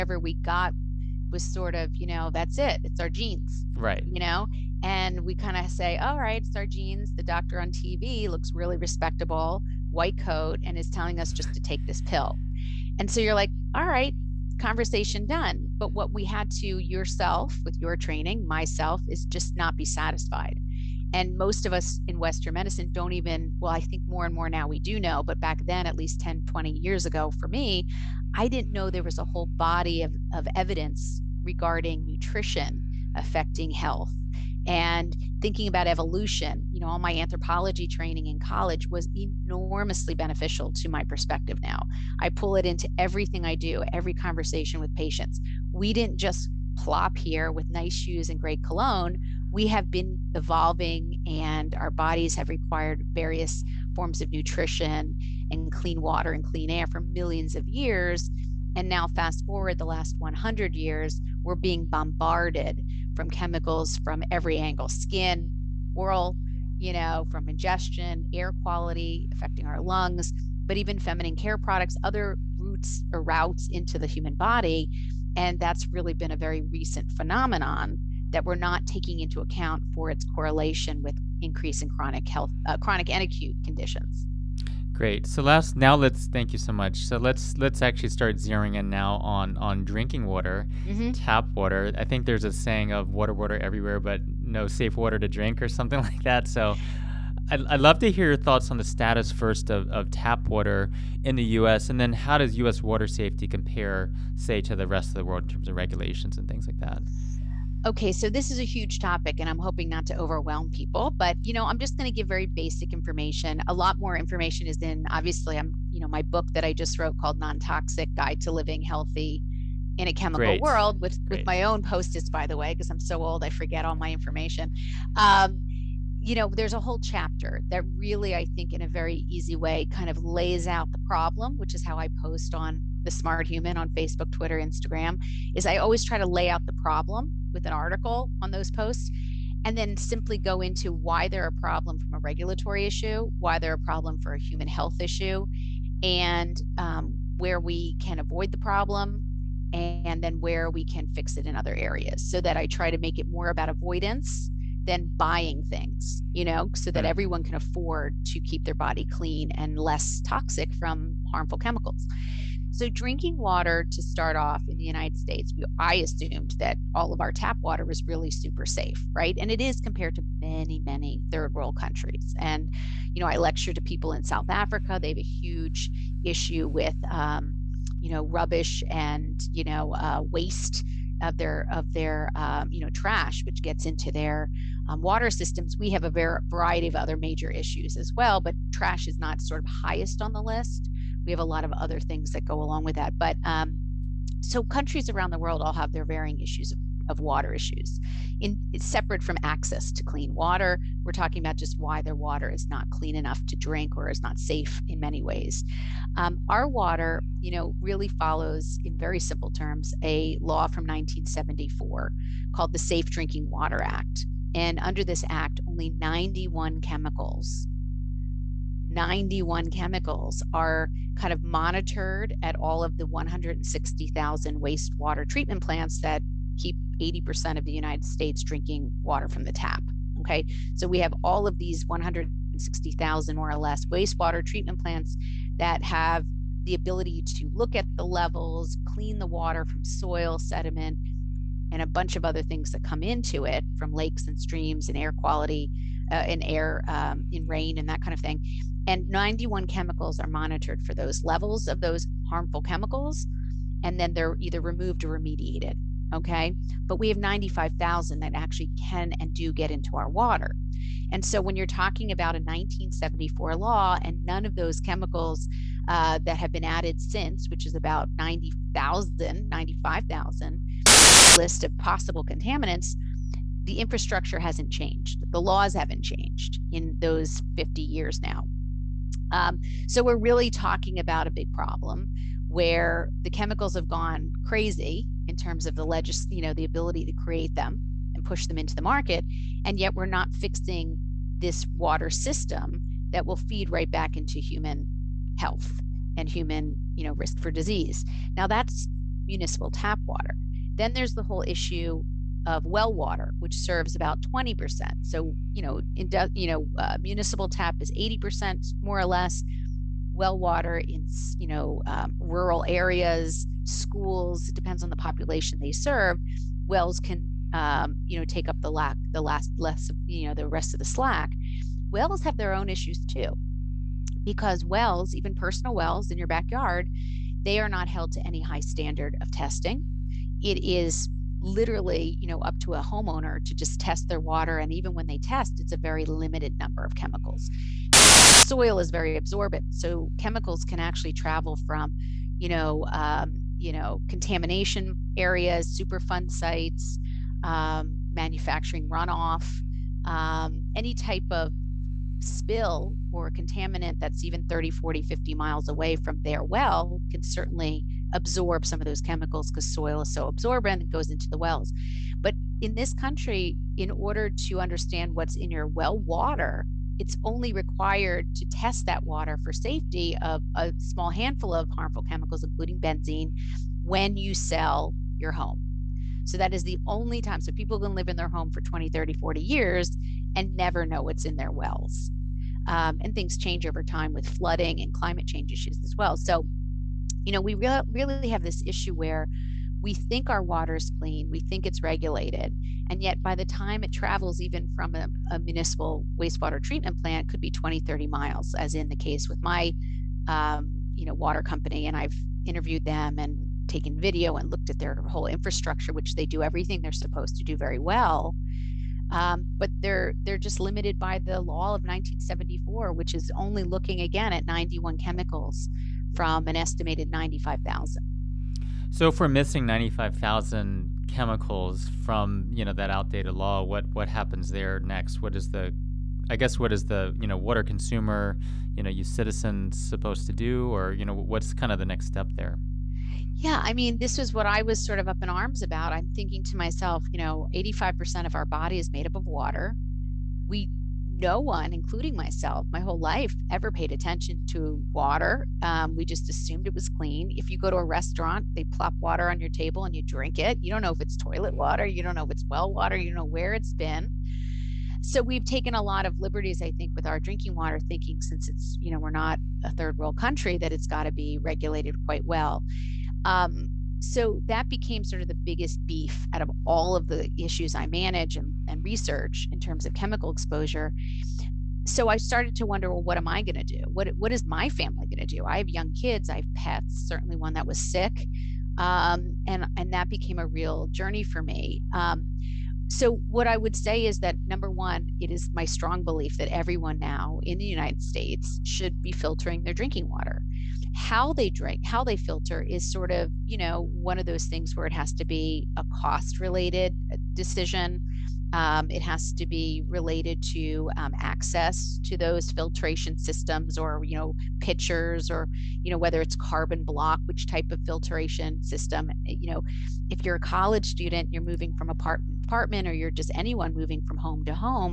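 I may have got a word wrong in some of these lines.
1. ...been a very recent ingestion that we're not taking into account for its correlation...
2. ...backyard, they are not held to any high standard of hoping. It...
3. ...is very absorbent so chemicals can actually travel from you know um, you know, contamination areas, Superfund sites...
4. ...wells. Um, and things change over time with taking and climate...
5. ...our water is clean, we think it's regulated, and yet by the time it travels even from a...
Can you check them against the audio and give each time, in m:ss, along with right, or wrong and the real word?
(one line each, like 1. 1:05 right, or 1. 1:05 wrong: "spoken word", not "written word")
1. 1:16 wrong: "phenomenon", not "ingestion"
2. 5:26 wrong: "testing", not "hoping"
3. 5:38 right
4. 6:21 wrong: "flooding", not "taking"
5. 6:30 right.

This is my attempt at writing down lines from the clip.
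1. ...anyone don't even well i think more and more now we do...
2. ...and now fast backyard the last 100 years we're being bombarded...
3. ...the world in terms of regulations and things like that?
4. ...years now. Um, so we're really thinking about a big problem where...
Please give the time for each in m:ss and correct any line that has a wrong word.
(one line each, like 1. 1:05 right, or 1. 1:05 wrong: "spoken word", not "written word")
1. 0:22 wrong: "medicine", not "anyone"
2. 0:58 wrong: "forward", not "backyard"
3. 1:45 right
4. 4:37 wrong: "talking", not "thinking".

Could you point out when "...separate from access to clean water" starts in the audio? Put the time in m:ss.
3:18.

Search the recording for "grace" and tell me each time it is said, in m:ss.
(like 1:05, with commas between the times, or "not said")
not said.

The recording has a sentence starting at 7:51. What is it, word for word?
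So I started to wonder, well, what am I going to do?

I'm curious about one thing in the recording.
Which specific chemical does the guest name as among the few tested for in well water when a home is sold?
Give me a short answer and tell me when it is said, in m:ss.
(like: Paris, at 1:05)
Benzene, at 6:12.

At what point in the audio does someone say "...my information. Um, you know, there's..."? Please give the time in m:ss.
2:03.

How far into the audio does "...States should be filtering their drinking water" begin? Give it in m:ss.
8:08.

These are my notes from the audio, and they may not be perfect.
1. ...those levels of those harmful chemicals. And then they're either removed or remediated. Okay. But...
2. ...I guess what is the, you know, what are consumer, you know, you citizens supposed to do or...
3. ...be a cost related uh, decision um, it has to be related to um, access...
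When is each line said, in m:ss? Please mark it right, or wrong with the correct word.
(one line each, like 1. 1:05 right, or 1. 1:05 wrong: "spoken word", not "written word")
1. 4:10 right
2. 7:06 right
3. 8:15 right.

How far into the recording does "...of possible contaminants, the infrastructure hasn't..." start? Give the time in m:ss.
4:31.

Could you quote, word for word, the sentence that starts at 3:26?
Um, our water, you know, really follows, in very simple terms, a law from 1974 called the Safe Drinking Water Act.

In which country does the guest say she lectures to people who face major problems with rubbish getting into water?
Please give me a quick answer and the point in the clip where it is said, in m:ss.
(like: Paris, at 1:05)
South Africa, at 2:54.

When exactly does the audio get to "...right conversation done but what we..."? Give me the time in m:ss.
0:13.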